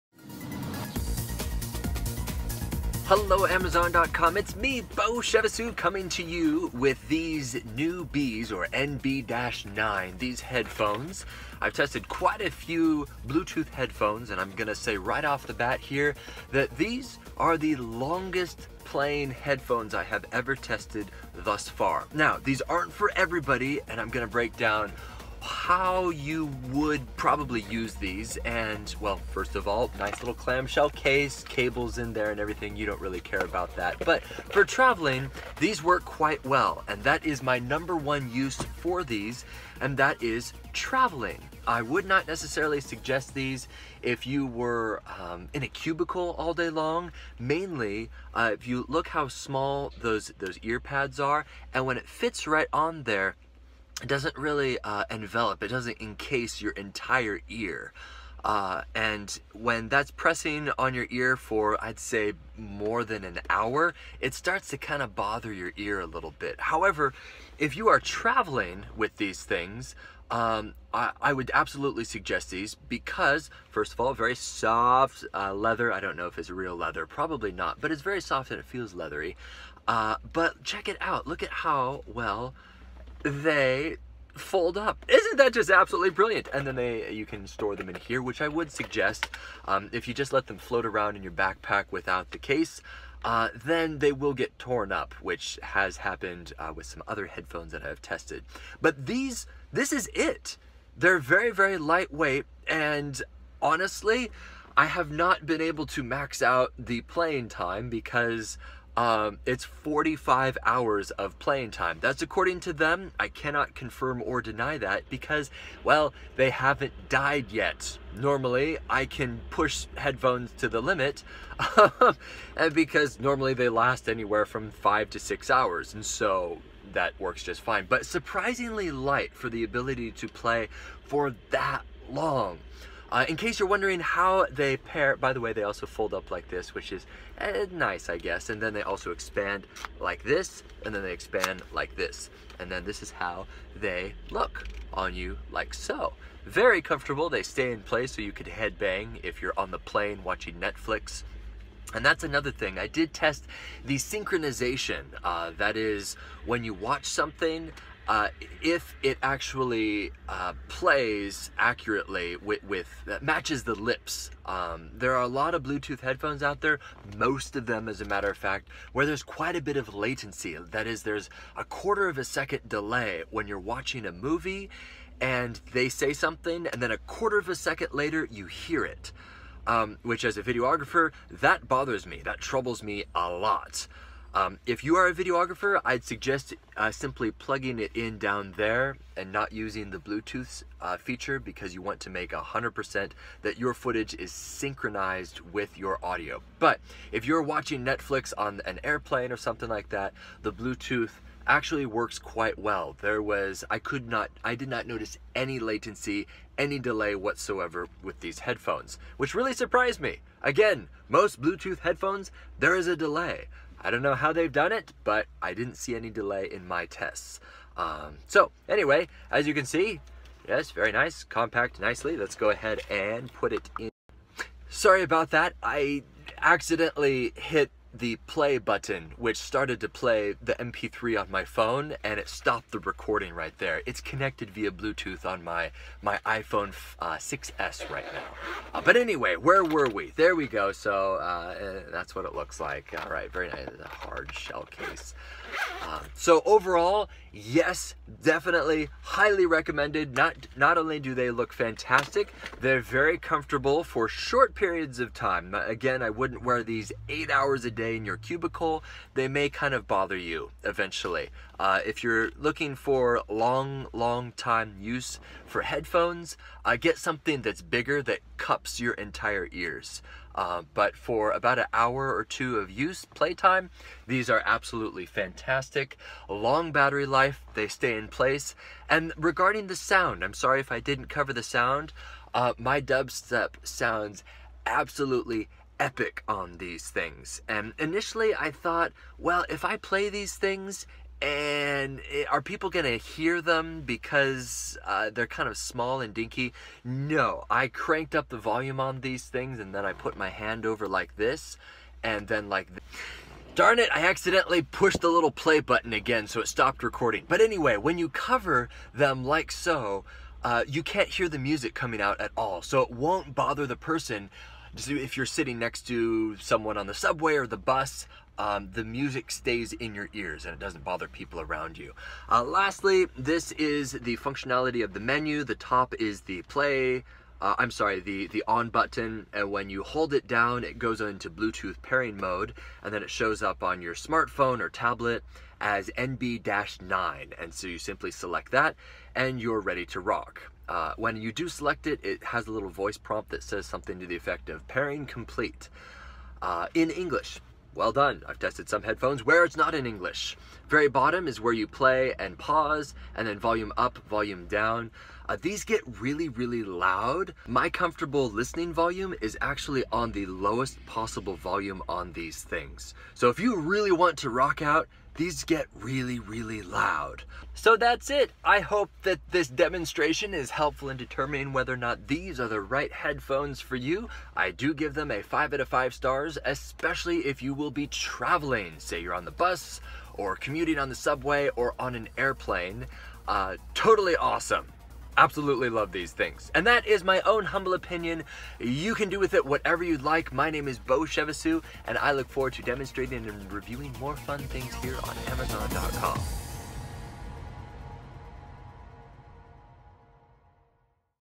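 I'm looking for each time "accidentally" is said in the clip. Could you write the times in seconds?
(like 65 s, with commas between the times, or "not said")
226 s, 304 s.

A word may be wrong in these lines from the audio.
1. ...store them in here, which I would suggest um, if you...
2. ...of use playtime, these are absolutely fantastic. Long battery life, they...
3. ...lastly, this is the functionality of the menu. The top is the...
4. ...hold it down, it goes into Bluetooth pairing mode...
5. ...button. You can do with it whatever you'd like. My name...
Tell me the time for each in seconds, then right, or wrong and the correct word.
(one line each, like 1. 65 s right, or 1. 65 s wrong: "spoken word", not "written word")
1. 87 s right
2. 272 s right
3. 322 s right
4. 329 s right
5. 387 s wrong: "opinion", not "button".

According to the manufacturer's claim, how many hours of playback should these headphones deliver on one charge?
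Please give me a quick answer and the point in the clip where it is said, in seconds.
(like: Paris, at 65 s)
45 hours, at 109 s.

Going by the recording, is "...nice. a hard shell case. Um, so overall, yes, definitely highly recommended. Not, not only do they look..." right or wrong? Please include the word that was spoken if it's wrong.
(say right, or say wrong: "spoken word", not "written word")
right.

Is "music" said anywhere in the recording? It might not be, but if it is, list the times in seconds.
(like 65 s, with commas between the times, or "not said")
311 s, 318 s.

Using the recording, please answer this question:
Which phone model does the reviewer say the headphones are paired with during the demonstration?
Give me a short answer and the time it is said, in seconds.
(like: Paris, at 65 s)
iPhone 6S, at 236 s.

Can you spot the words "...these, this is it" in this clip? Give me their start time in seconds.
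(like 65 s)
99 s.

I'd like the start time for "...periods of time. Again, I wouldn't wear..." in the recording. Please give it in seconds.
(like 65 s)
254 s.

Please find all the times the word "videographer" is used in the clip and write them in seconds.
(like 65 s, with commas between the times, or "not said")
180 s, 185 s.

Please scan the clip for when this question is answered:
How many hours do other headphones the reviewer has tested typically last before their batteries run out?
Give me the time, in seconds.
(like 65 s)
124 s.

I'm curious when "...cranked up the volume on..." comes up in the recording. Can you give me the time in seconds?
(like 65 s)
297 s.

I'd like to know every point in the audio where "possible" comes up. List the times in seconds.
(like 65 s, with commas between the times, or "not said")
360 s.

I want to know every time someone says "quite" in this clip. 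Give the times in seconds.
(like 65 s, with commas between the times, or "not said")
12 s, 36 s, 169 s, 202 s.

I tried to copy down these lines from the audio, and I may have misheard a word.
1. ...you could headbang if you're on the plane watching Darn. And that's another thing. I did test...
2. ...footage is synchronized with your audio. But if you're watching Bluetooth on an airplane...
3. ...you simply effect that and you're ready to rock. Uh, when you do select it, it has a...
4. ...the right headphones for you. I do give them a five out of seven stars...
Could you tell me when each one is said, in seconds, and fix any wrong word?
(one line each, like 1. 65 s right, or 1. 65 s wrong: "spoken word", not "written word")
1. 148 s wrong: "Netflix", not "Darn"
2. 193 s wrong: "Netflix", not "Bluetooth"
3. 337 s wrong: "select", not "effect"
4. 372 s wrong: "five", not "seven".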